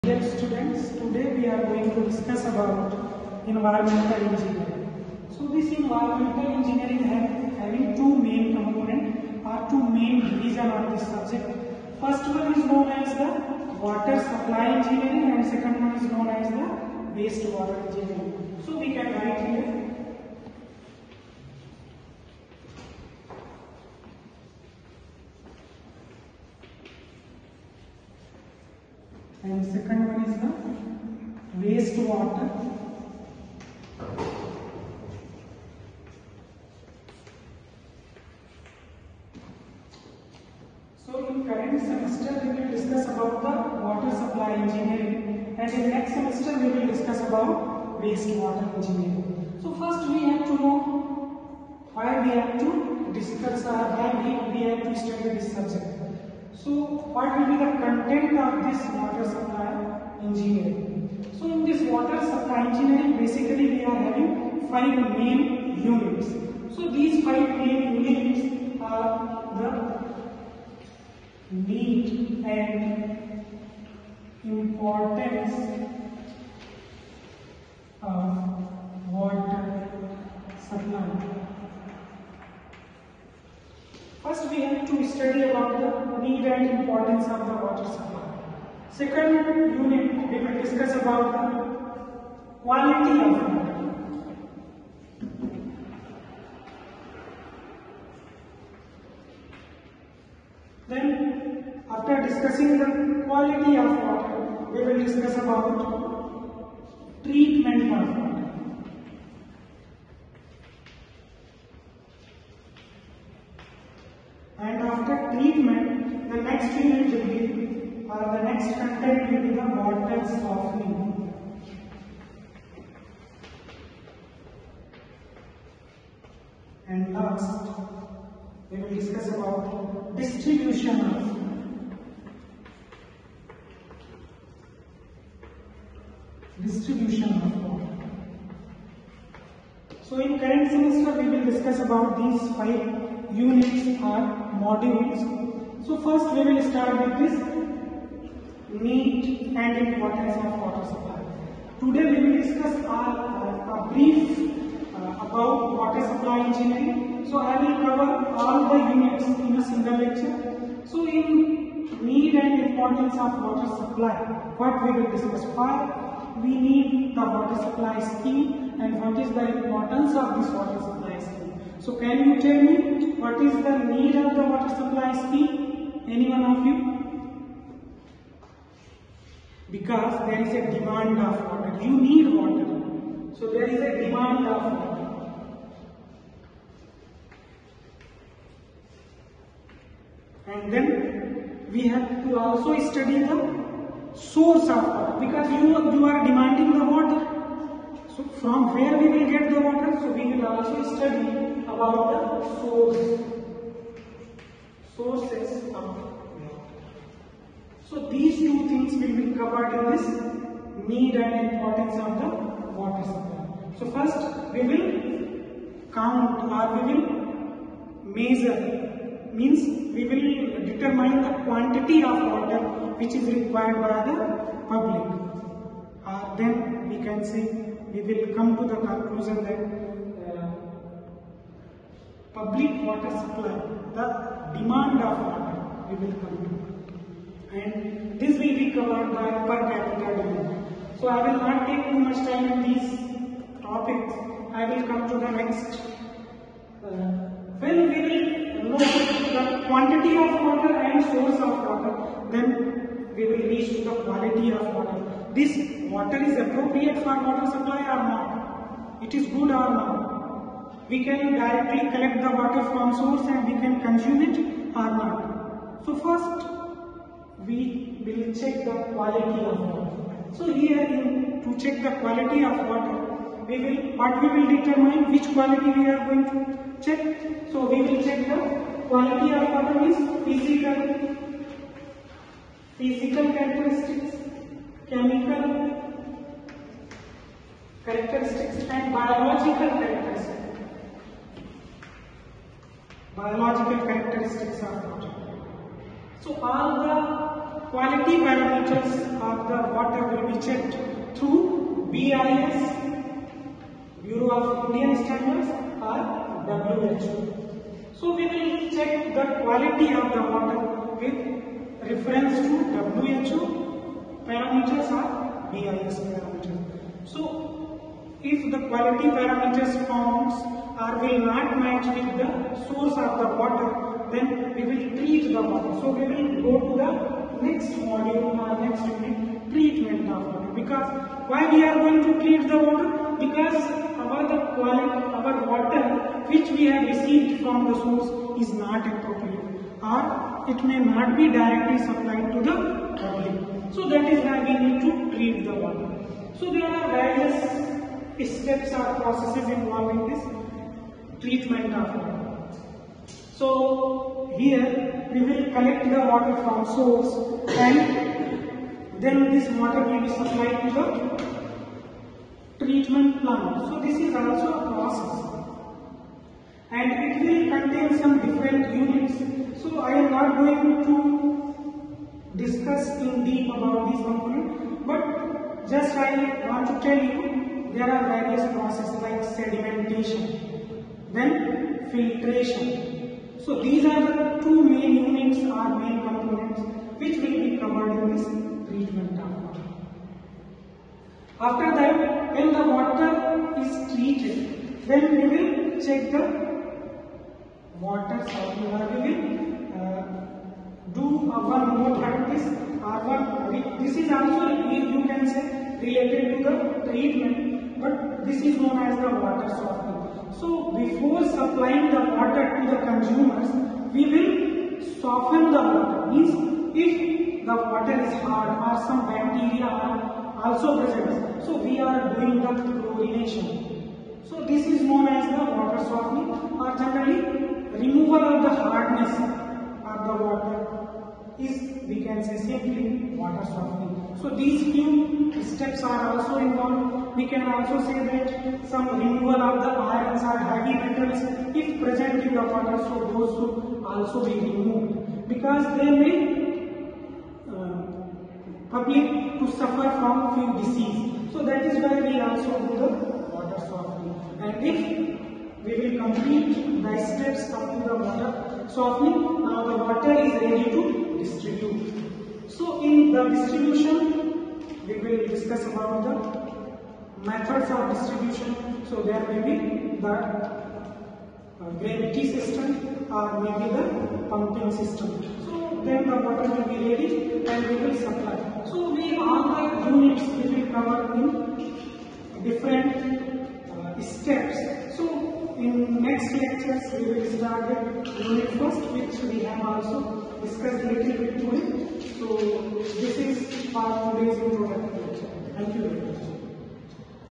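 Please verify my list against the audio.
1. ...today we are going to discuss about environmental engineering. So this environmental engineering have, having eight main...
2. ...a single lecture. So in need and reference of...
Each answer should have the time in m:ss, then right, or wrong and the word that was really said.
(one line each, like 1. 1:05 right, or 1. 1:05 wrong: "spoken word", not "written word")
1. 0:01 wrong: "two", not "eight"
2. 2:39 wrong: "importance", not "reference".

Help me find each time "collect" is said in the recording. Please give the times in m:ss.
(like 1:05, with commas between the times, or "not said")
4:21, 5:55.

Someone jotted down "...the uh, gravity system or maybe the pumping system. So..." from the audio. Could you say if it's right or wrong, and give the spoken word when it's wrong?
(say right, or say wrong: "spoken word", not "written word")
right.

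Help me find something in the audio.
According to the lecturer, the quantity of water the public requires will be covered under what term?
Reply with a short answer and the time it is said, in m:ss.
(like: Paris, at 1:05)
Per capita demand, at 3:59.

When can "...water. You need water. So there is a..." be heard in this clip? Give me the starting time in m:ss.
3:01.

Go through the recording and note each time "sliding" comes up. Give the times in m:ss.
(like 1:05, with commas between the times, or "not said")
not said.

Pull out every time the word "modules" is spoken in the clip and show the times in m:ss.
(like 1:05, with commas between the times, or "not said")
2:24, 5:27.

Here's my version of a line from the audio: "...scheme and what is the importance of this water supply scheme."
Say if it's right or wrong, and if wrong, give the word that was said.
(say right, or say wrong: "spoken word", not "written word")
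right.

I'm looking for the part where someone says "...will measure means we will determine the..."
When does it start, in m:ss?
3:36.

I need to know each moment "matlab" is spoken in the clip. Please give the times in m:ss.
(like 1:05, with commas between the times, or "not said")
not said.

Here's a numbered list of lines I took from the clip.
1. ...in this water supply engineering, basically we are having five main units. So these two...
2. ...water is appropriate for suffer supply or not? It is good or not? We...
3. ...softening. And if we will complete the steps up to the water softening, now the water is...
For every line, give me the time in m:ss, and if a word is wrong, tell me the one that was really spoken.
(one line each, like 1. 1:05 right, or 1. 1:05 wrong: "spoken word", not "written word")
1. 1:01 wrong: "five", not "two"
2. 4:15 wrong: "water", not "suffer"
3. 7:33 right.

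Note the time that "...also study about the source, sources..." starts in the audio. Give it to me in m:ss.
3:20.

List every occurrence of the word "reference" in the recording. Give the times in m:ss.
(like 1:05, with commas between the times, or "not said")
5:11.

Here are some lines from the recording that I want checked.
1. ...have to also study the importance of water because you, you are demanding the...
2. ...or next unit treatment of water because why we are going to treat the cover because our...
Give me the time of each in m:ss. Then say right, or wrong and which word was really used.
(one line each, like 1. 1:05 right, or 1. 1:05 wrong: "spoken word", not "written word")
1. 3:11 wrong: "source", not "importance"
2. 5:28 wrong: "water", not "cover".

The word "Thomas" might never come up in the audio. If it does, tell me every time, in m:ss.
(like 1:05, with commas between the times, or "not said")
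not said.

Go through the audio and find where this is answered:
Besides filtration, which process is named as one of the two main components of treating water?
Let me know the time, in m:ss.
6:19.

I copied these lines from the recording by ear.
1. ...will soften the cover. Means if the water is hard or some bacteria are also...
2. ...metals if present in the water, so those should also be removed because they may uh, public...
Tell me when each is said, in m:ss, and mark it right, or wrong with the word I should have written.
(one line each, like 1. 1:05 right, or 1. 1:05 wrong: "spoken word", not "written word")
1. 6:54 wrong: "water", not "cover"
2. 7:20 right.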